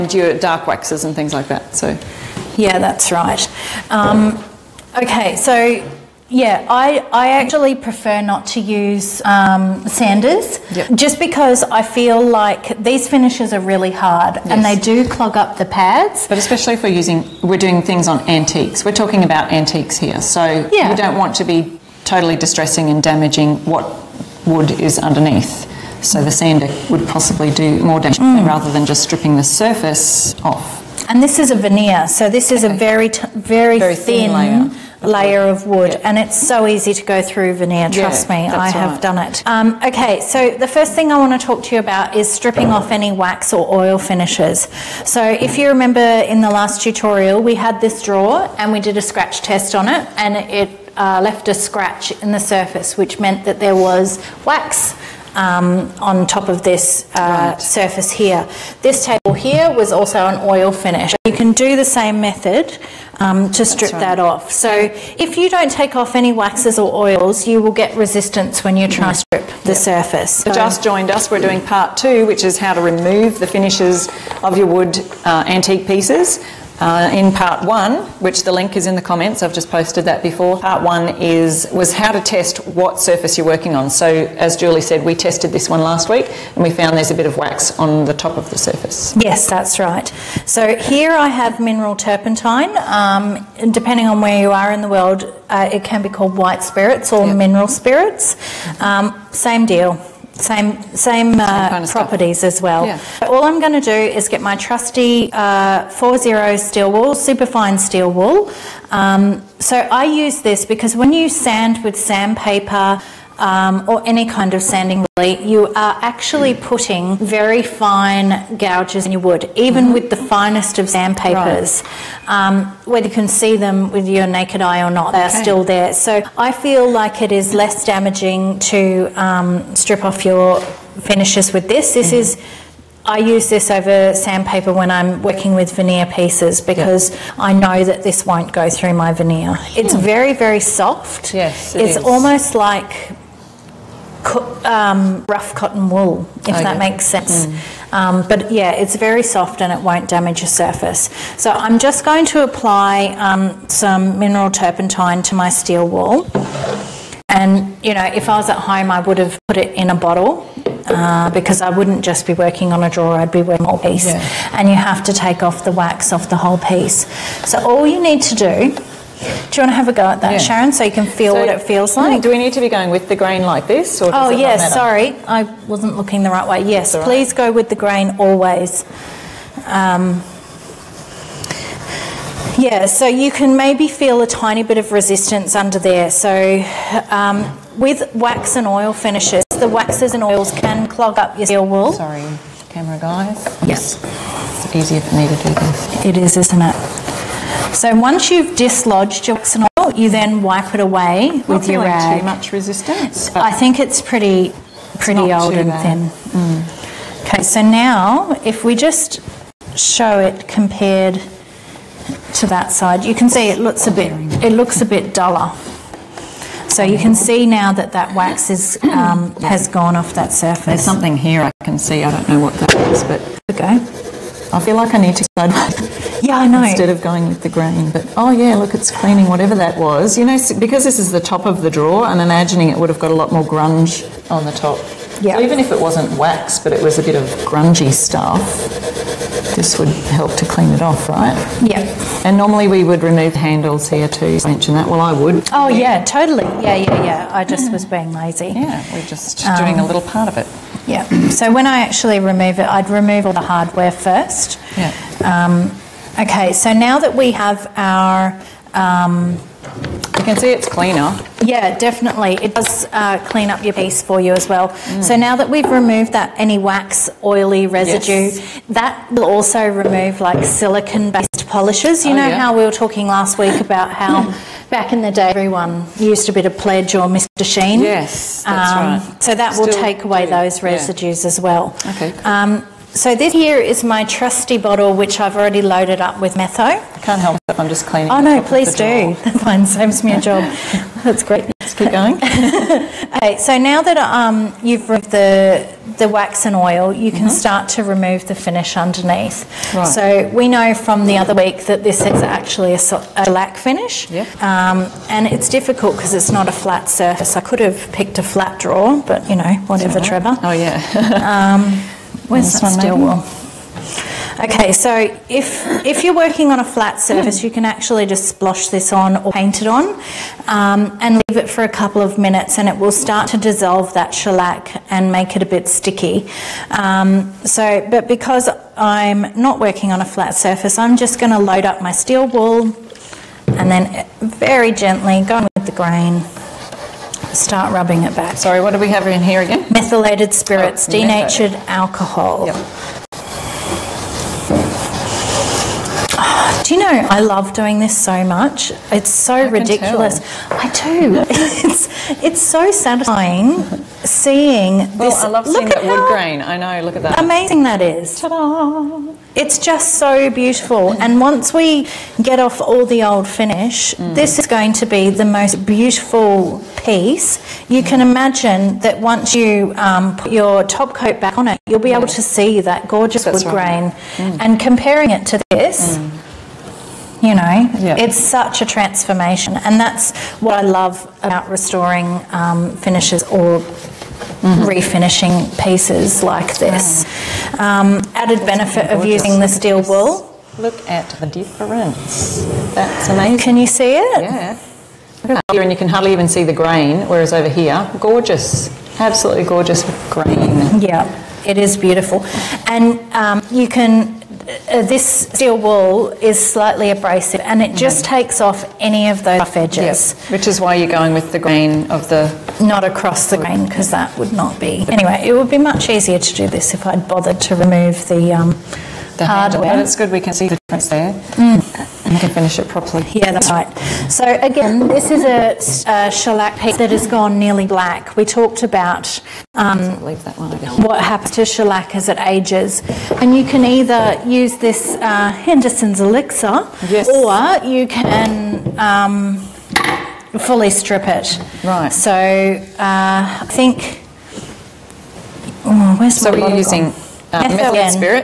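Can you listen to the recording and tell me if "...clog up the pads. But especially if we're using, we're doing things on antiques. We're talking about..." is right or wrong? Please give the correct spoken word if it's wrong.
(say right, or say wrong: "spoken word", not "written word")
right.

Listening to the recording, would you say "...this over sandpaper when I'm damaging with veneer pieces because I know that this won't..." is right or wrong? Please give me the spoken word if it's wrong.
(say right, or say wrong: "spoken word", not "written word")
wrong: "working", not "damaging".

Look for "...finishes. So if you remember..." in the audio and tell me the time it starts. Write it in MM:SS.
00:43.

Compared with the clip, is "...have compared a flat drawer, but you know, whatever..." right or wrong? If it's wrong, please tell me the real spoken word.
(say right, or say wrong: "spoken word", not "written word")
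wrong: "picked", not "compared".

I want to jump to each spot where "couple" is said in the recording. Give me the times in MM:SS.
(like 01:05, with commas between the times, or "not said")
05:21.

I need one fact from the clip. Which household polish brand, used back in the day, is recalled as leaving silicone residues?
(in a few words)
Pledge.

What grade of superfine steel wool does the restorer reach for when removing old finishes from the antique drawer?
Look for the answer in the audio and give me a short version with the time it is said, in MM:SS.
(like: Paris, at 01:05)
40, at 01:45.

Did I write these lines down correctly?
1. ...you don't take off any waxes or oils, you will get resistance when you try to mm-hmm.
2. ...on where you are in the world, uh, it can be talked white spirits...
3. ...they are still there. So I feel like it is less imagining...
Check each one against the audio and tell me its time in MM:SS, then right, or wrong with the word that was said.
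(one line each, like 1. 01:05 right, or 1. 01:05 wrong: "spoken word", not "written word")
1. 01:05 right
2. 01:34 wrong: "called", not "talked"
3. 02:05 wrong: "damaging", not "imagining".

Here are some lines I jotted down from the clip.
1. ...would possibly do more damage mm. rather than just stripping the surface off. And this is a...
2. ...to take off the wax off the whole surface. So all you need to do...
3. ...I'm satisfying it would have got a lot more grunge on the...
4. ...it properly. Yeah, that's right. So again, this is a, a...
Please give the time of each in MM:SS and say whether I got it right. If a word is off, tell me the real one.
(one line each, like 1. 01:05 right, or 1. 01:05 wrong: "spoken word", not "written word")
1. 00:26 right
2. 02:45 wrong: "piece", not "surface"
3. 03:52 wrong: "imagining", not "satisfying"
4. 07:02 right.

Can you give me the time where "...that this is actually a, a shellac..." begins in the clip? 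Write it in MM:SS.
05:01.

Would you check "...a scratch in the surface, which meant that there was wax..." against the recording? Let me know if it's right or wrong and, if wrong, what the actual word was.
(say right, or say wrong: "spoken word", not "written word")
right.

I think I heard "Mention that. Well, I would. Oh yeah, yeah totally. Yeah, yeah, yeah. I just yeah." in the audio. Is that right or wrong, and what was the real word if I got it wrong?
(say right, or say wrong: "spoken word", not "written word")
right.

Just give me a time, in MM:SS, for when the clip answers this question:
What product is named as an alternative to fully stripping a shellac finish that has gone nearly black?
07:15.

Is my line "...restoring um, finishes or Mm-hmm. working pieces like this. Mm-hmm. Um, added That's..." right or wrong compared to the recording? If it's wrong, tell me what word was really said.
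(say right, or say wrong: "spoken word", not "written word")
wrong: "refinishing", not "working".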